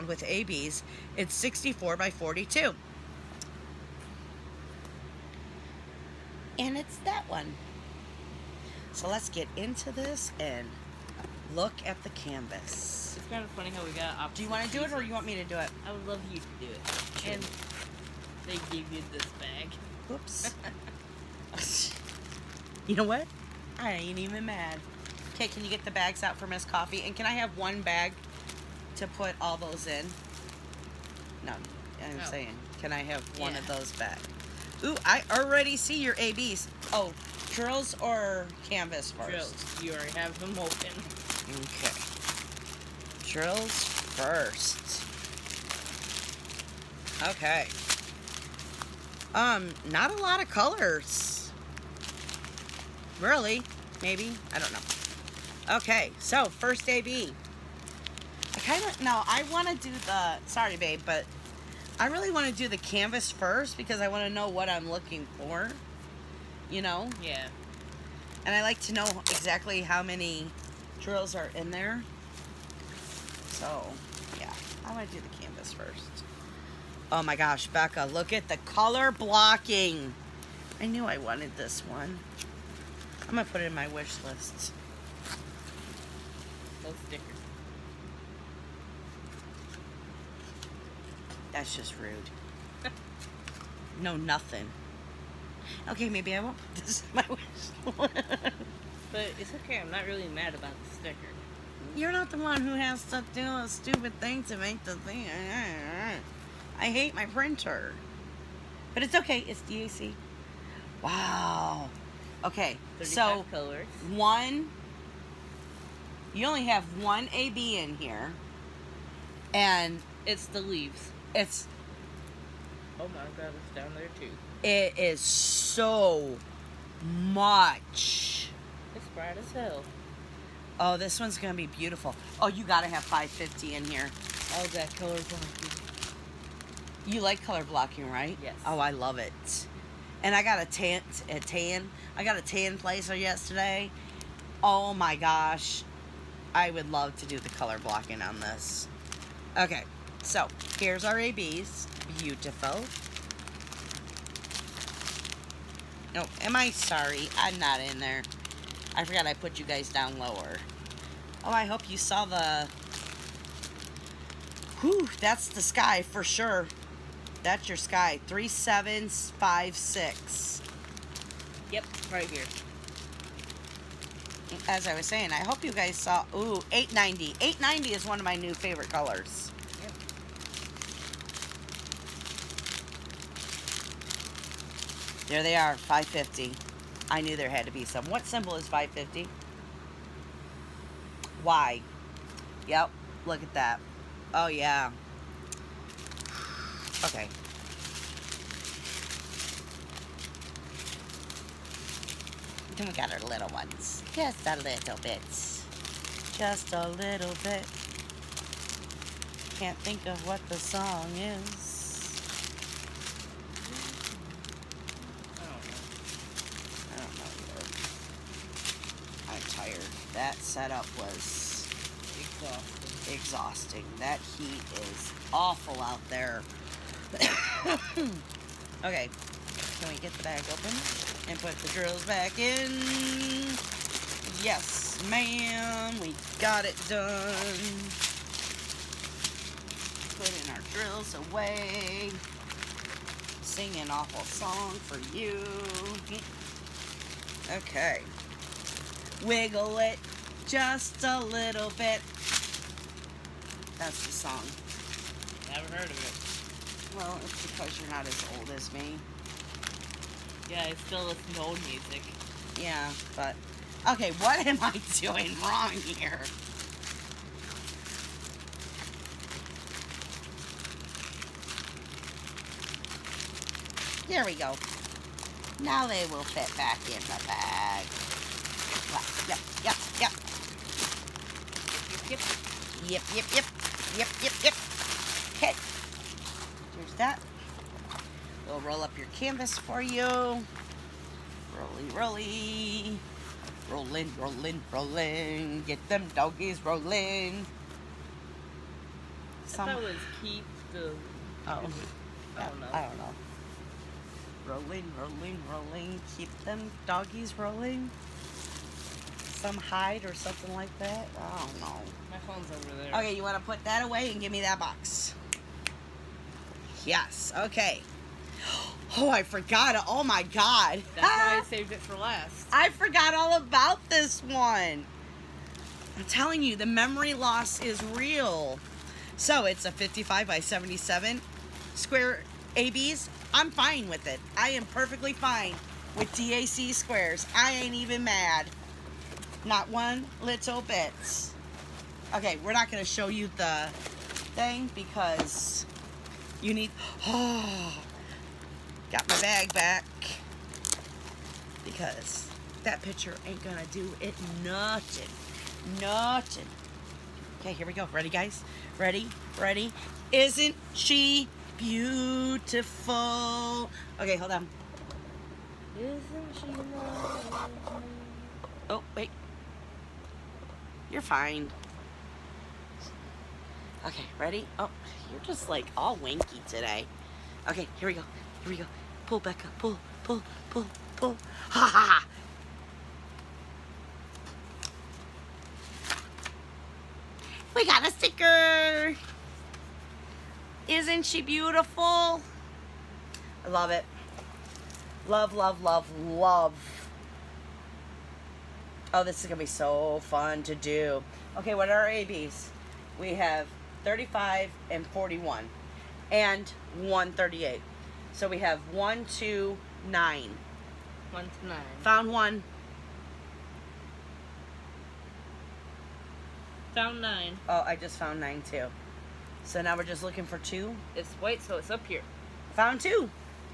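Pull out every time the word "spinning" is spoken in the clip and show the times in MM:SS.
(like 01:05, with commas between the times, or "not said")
not said.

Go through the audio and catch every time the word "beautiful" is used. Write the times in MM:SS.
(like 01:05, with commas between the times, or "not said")
02:11, 02:32, 06:01, 06:31.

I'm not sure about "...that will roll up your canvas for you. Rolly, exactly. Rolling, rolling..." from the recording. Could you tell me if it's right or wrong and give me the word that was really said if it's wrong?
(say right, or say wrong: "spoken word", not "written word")
wrong: "rolly", not "exactly".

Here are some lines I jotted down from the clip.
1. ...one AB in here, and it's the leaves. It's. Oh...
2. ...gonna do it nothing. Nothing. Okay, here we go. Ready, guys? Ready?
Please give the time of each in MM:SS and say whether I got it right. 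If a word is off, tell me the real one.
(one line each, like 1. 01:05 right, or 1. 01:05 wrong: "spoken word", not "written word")
1. 01:57 right
2. 05:53 right.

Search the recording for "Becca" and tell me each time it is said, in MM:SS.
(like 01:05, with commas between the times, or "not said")
01:17, 06:19.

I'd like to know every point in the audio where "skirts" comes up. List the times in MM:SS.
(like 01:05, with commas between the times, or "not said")
not said.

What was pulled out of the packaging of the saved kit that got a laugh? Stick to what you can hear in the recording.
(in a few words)
A sticker.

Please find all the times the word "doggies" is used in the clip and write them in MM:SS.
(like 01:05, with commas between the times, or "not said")
04:56, 05:06.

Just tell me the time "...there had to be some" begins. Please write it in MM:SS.
03:07.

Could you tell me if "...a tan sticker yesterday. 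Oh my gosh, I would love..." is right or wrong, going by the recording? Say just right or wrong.
wrong.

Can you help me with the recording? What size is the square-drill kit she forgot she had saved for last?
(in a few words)
55 by 77.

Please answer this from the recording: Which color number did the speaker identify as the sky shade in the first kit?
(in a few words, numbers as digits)
3756.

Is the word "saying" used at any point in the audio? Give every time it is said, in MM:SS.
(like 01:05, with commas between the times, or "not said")
00:32, 02:55.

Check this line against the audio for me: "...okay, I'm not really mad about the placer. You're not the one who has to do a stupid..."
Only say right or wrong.
wrong.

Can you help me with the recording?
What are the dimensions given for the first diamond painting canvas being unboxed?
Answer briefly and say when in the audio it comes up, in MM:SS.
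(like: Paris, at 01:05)
64 by 42, at 00:01.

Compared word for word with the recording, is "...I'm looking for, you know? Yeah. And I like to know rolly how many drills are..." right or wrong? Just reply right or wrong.
wrong.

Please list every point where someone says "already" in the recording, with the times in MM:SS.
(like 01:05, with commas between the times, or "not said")
00:35, 00:39.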